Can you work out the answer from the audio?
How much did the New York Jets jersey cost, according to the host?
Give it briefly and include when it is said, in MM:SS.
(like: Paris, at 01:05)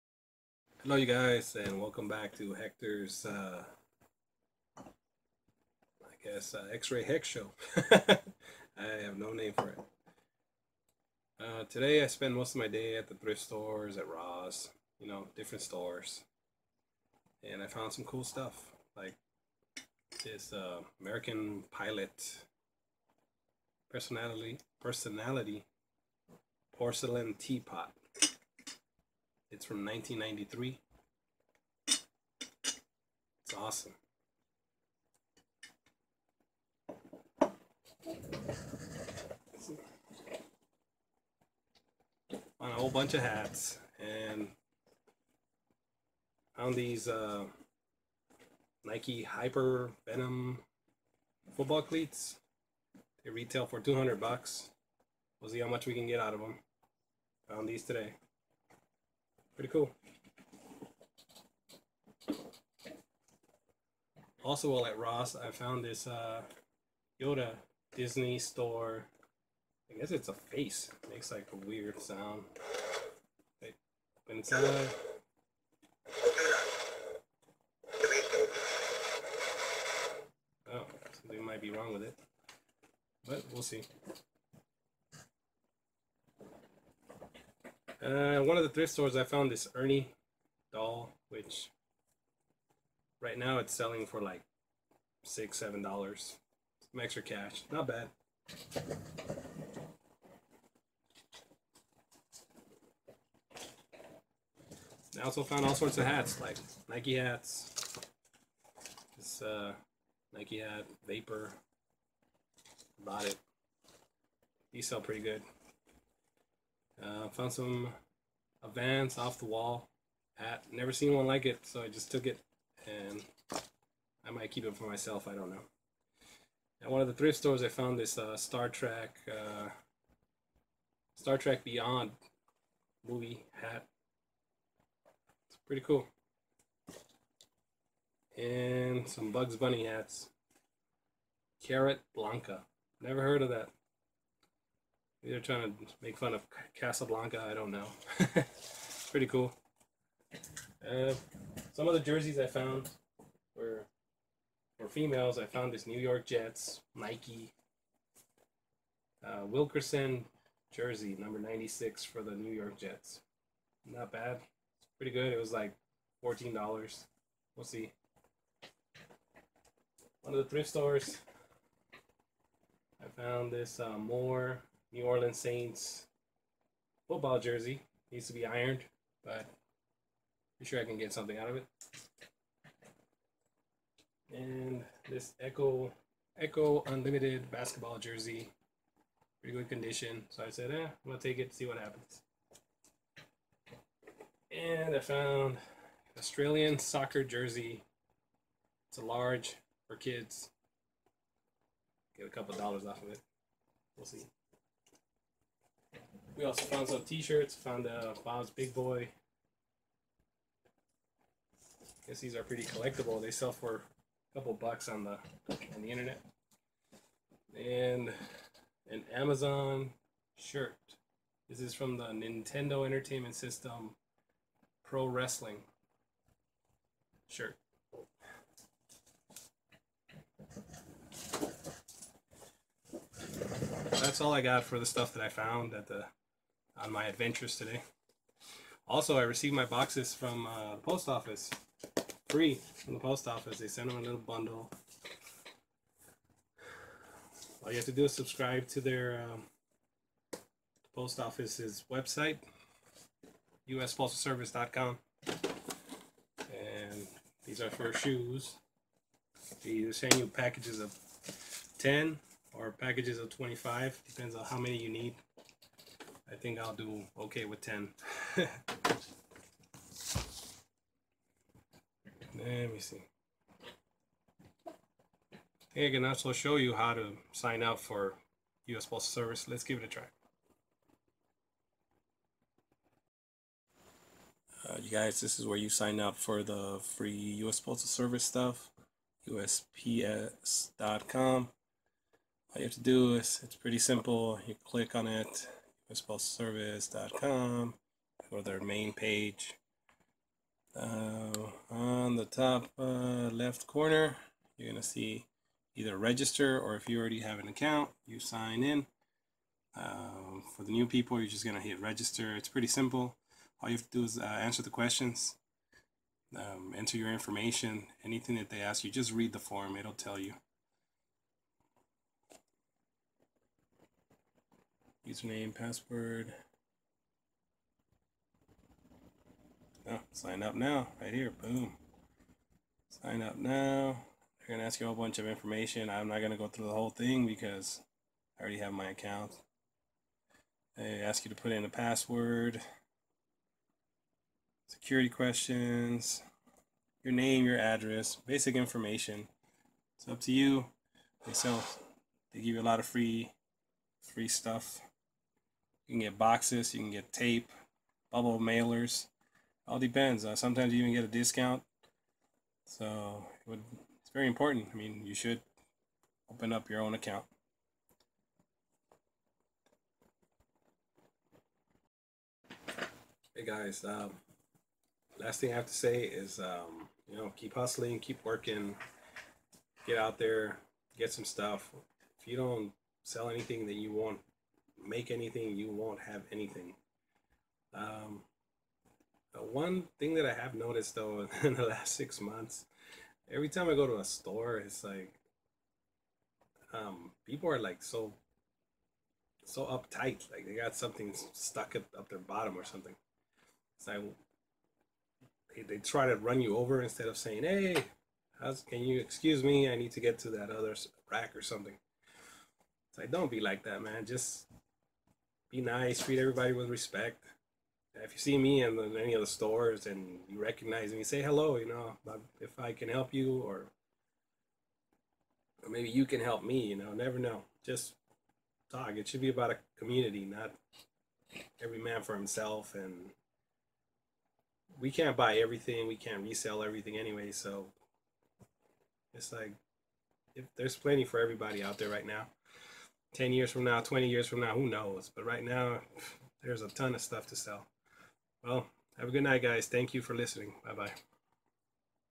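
$14, at 02:46.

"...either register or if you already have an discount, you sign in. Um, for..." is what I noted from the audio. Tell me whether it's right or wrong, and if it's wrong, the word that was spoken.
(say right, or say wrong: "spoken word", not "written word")
wrong: "account", not "discount".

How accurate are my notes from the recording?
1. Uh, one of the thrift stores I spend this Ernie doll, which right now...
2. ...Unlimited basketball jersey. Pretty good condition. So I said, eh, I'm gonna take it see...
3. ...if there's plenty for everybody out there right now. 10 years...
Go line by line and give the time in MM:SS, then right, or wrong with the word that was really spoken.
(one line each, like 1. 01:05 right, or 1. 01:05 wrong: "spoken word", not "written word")
1. 01:28 wrong: "found", not "spend"
2. 03:06 right
3. 07:20 right.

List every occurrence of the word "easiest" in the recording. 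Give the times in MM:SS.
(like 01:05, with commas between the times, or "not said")
not said.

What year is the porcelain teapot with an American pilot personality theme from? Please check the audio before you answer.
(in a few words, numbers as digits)
1993.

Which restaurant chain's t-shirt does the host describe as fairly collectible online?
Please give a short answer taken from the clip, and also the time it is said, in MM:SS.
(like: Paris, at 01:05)
Bob's Big Boy, at 03:28.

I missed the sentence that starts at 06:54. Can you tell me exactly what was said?
Just be nice, treat everybody with respect.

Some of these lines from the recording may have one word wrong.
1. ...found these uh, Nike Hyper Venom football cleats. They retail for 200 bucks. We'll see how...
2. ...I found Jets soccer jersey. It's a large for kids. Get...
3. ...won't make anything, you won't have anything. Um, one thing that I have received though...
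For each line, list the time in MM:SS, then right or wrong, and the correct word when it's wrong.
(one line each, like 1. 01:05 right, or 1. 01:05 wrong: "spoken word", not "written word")
1. 00:46 right
2. 03:14 wrong: "Australian", not "Jets"
3. 06:23 wrong: "noticed", not "received".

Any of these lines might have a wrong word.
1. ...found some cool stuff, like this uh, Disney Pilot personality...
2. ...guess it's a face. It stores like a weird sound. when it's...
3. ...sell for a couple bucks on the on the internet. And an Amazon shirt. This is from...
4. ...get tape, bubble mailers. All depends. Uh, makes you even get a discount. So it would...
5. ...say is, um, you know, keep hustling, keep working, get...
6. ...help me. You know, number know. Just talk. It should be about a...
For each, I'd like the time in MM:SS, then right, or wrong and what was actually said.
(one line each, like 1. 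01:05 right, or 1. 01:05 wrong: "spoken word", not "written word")
1. 00:17 wrong: "American", not "Disney"
2. 01:09 wrong: "makes", not "stores"
3. 03:33 right
4. 05:56 wrong: "sometimes", not "makes"
5. 06:15 right
6. 07:06 wrong: "never", not "number".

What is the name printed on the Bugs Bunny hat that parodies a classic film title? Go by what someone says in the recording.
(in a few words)
Carrot Blanca.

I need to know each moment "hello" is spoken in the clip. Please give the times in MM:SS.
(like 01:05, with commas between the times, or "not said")
00:00, 07:01.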